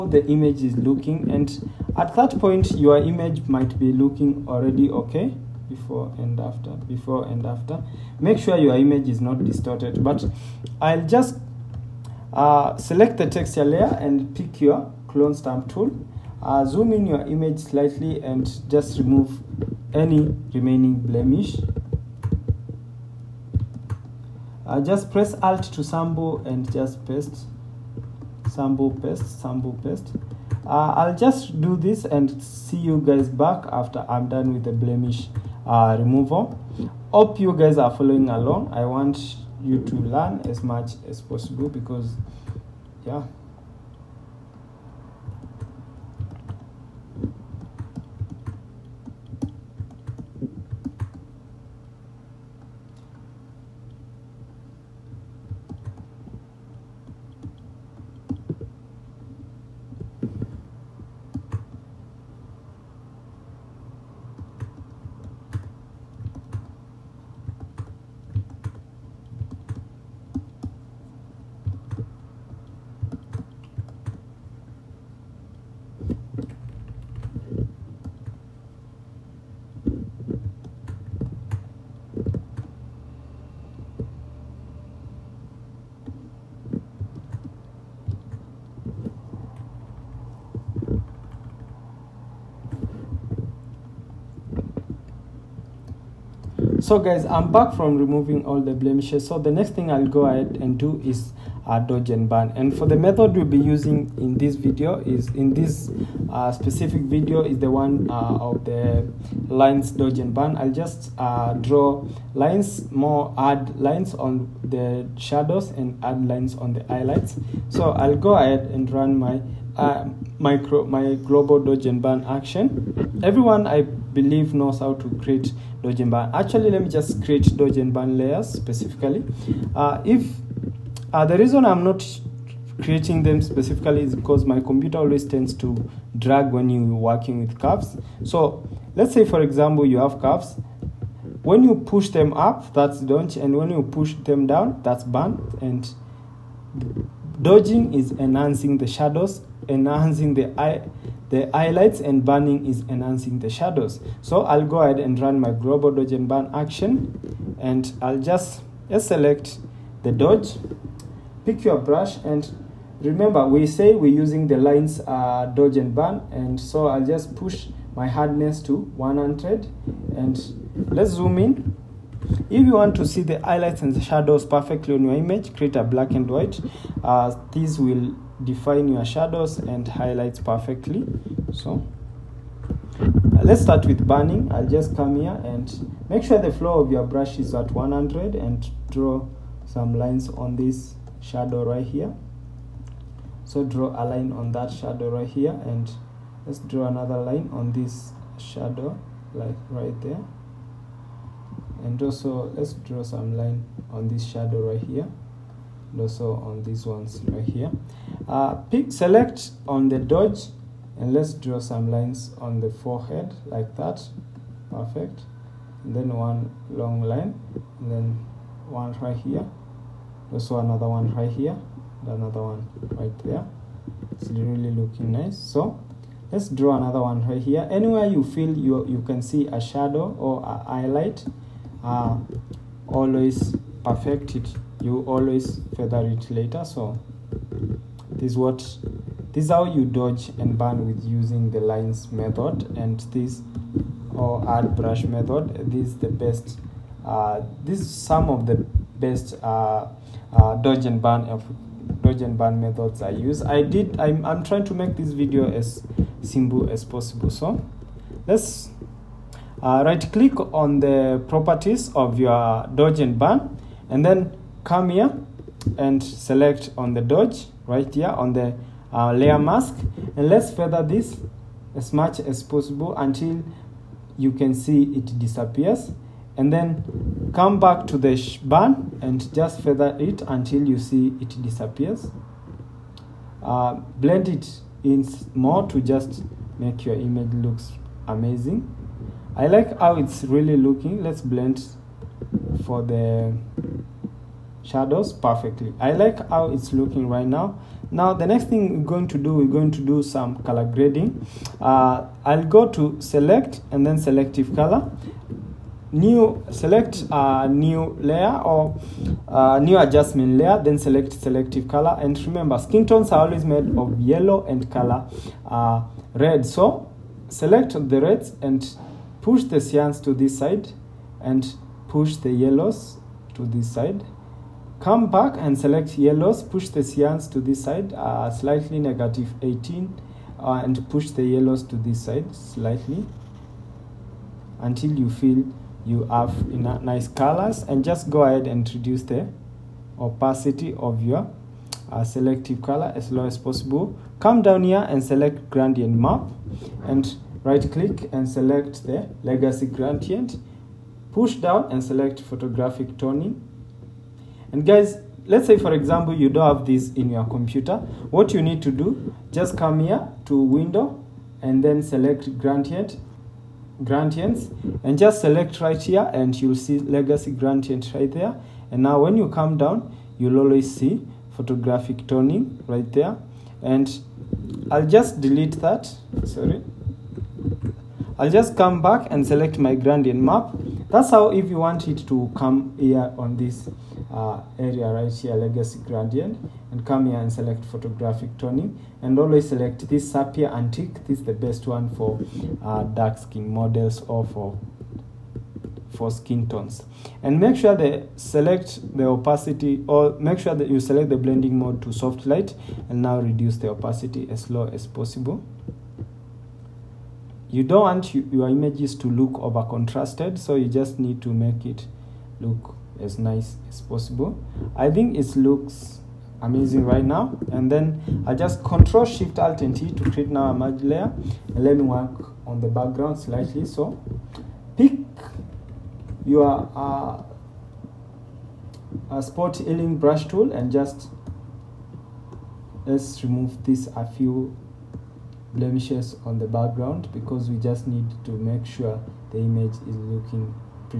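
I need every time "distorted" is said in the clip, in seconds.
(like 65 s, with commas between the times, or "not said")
9 s.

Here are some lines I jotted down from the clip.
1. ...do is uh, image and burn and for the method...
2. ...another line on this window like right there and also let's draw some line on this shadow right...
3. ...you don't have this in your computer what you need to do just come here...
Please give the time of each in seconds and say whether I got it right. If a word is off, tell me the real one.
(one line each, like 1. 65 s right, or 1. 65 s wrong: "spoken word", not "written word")
1. 100 s wrong: "dodge", not "image"
2. 196 s wrong: "shadow", not "window"
3. 356 s right.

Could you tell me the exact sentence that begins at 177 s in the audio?
Uh, this will define your shadows and highlights perfectly.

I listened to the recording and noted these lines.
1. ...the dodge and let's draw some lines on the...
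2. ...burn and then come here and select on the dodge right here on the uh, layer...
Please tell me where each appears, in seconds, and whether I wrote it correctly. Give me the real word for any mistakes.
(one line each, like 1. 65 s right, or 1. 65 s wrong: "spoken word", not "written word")
1. 209 s right
2. 263 s right.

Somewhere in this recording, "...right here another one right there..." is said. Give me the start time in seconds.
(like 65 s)
221 s.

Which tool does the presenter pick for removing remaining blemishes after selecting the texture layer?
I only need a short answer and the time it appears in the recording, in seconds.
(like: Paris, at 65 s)
Clone stamp tool, at 15 s.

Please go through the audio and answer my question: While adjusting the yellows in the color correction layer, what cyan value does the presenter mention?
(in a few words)
-18.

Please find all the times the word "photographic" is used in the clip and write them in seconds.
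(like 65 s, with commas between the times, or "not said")
352 s, 371 s, 387 s.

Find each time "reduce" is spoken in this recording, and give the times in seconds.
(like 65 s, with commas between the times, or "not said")
338 s, 403 s.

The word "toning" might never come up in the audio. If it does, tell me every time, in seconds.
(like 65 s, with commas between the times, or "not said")
352 s, 372 s, 388 s.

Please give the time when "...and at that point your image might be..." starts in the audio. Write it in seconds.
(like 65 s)
1 s.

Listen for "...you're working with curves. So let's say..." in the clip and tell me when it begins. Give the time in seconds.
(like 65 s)
136 s.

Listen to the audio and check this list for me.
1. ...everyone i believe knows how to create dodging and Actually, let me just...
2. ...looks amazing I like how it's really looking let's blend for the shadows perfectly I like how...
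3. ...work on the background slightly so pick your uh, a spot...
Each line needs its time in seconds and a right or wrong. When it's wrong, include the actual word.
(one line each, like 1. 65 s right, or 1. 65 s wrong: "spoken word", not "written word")
1. 123 s right
2. 287 s right
3. 421 s right.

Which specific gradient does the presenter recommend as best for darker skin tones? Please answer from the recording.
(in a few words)
Sapphire Antique.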